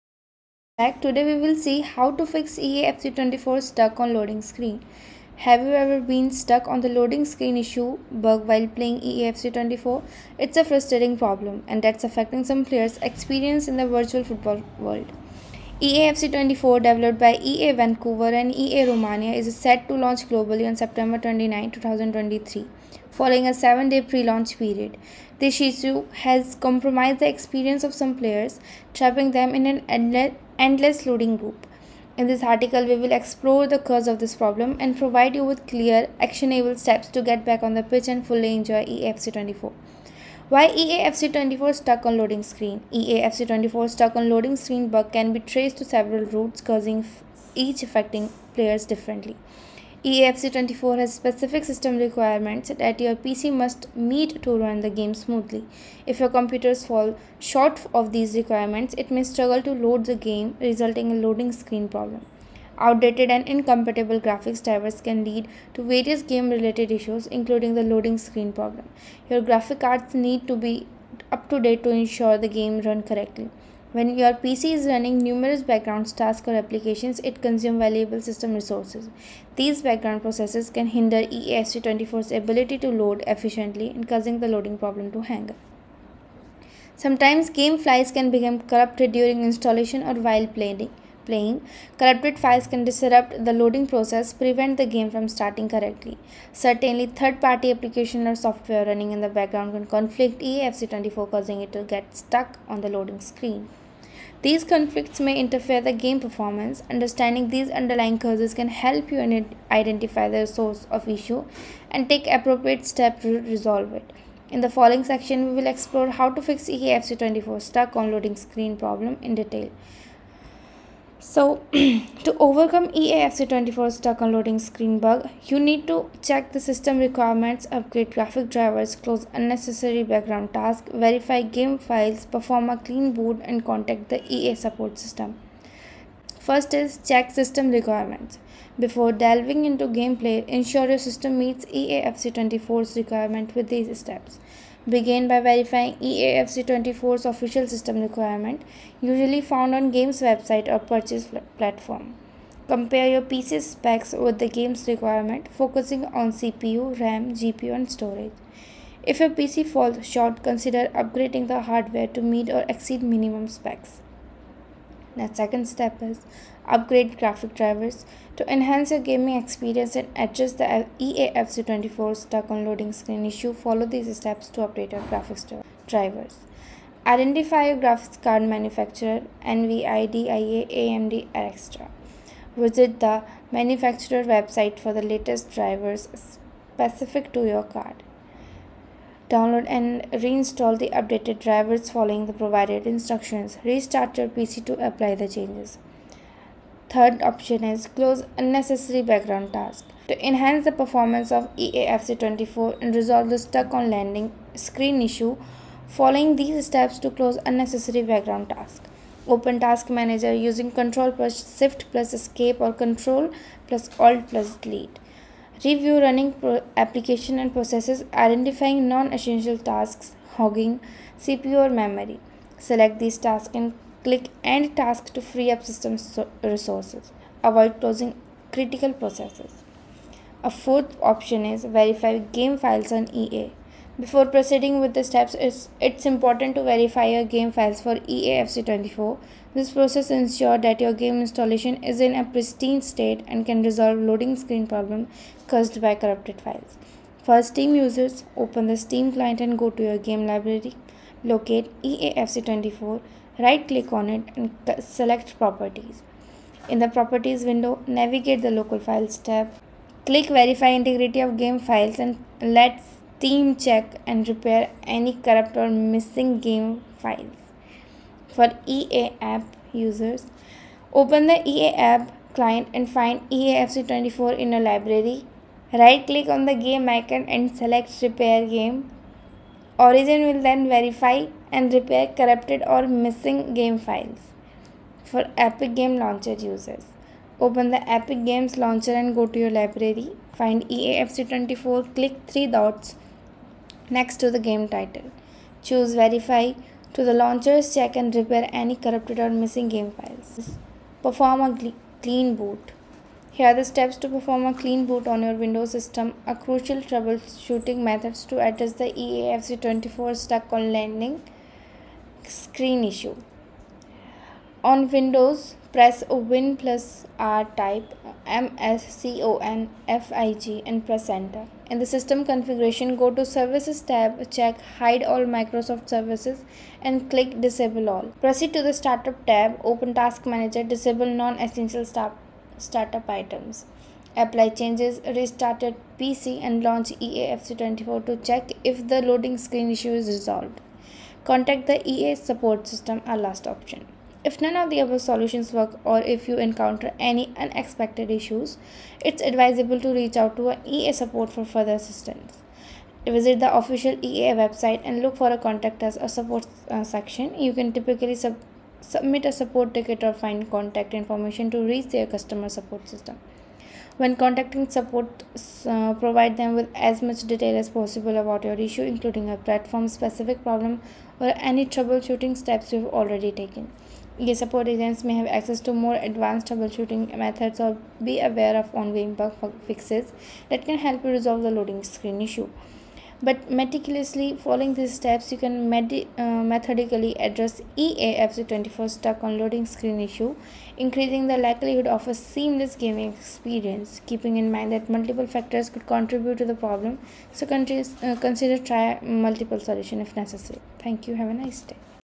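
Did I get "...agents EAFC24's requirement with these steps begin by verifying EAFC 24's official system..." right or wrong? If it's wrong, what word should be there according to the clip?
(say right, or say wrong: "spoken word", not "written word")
wrong: "meets", not "agents".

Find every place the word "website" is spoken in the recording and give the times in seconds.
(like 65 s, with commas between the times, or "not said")
150 s, 184 s, 354 s.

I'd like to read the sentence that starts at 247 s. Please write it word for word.
For Steam users, open the Steam client and go to your game library, locate EAFC24, right click on it and select properties.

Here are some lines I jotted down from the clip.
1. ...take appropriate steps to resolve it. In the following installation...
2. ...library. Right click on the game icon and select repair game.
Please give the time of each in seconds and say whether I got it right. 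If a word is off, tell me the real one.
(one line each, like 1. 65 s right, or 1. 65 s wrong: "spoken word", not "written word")
1. 112 s wrong: "section", not "installation"
2. 274 s right.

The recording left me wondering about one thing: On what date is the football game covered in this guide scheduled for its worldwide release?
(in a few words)
September 29, 2023.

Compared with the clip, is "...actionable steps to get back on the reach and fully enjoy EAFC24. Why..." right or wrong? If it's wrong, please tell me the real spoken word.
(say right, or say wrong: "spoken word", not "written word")
wrong: "pitch", not "reach".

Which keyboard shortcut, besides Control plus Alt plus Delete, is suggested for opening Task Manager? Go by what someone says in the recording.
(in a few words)
Control plus Shift plus Escape.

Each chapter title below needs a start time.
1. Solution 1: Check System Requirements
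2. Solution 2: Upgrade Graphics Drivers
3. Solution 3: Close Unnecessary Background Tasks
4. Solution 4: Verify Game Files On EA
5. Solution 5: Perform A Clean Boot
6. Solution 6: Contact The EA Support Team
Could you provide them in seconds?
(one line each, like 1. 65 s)
1. 118 s
2. 166 s
3. 198 s
4. 232 s
5. 300 s
6. 345 s.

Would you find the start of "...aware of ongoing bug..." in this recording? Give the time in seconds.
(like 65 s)
378 s.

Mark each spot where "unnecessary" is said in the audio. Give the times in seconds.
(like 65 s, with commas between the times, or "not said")
129 s, 198 s, 207 s.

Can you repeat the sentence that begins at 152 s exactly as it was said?
Compare your PC specs with the game's requirement, focusing on CPU, RAM, GPU, and storage.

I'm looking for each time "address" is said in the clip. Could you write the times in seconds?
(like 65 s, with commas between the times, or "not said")
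170 s, 308 s, 387 s.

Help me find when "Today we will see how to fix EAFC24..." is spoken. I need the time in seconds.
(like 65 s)
1 s.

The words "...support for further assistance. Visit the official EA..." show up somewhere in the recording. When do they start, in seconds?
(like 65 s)
350 s.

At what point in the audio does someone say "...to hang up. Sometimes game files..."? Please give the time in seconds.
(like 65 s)
85 s.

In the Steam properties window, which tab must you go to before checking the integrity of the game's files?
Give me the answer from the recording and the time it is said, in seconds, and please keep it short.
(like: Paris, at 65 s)
local files, at 258 s.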